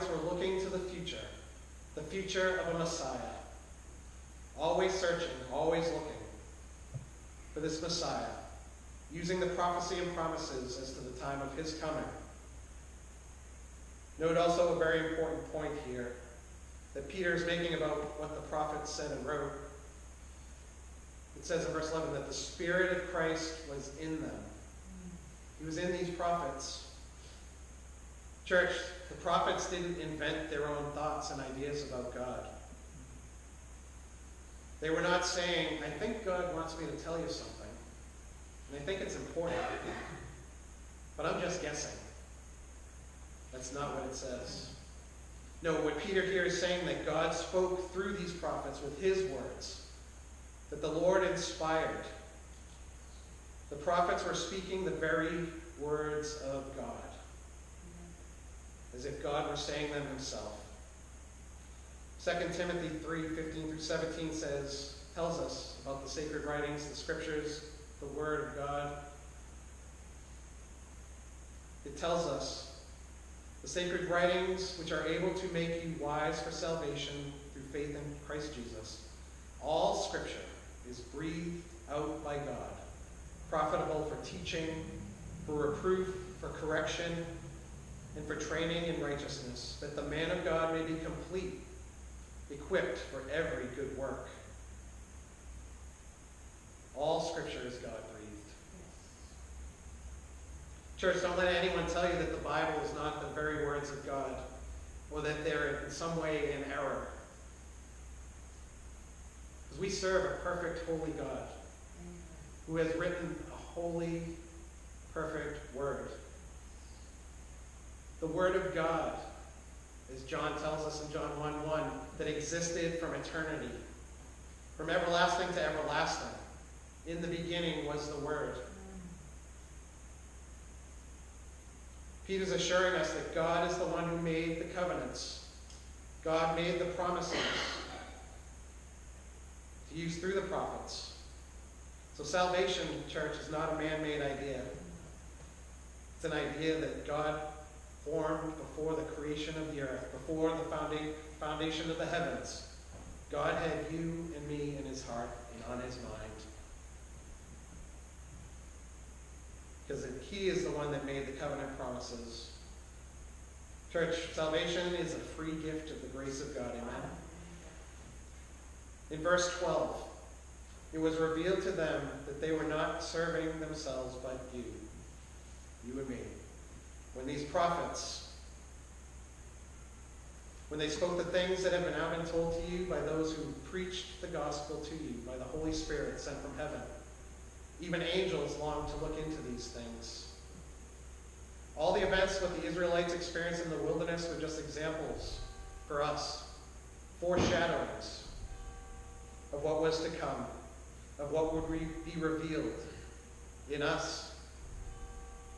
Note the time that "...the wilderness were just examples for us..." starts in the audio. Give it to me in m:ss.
3:13.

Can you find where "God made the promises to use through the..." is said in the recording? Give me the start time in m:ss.
2:16.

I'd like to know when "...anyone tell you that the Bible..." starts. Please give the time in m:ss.
1:41.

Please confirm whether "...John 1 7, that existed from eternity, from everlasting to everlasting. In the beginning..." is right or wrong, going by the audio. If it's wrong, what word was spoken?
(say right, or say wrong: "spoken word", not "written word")
wrong: "1", not "7".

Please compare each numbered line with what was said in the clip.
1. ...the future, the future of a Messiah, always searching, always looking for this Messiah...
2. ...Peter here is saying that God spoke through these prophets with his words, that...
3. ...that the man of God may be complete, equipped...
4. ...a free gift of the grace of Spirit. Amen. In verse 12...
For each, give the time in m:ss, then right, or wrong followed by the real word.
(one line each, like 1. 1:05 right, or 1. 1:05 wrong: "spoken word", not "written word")
1. 0:00 right
2. 0:45 right
3. 1:29 right
4. 2:45 wrong: "God", not "Spirit".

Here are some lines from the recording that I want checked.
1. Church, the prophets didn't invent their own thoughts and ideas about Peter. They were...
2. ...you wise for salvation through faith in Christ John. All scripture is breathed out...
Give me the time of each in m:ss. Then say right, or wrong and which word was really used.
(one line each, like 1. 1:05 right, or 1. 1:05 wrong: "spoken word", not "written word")
1. 0:28 wrong: "God", not "Peter"
2. 1:15 wrong: "Jesus", not "John".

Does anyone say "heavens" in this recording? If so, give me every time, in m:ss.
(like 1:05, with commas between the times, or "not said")
2:32, 3:06.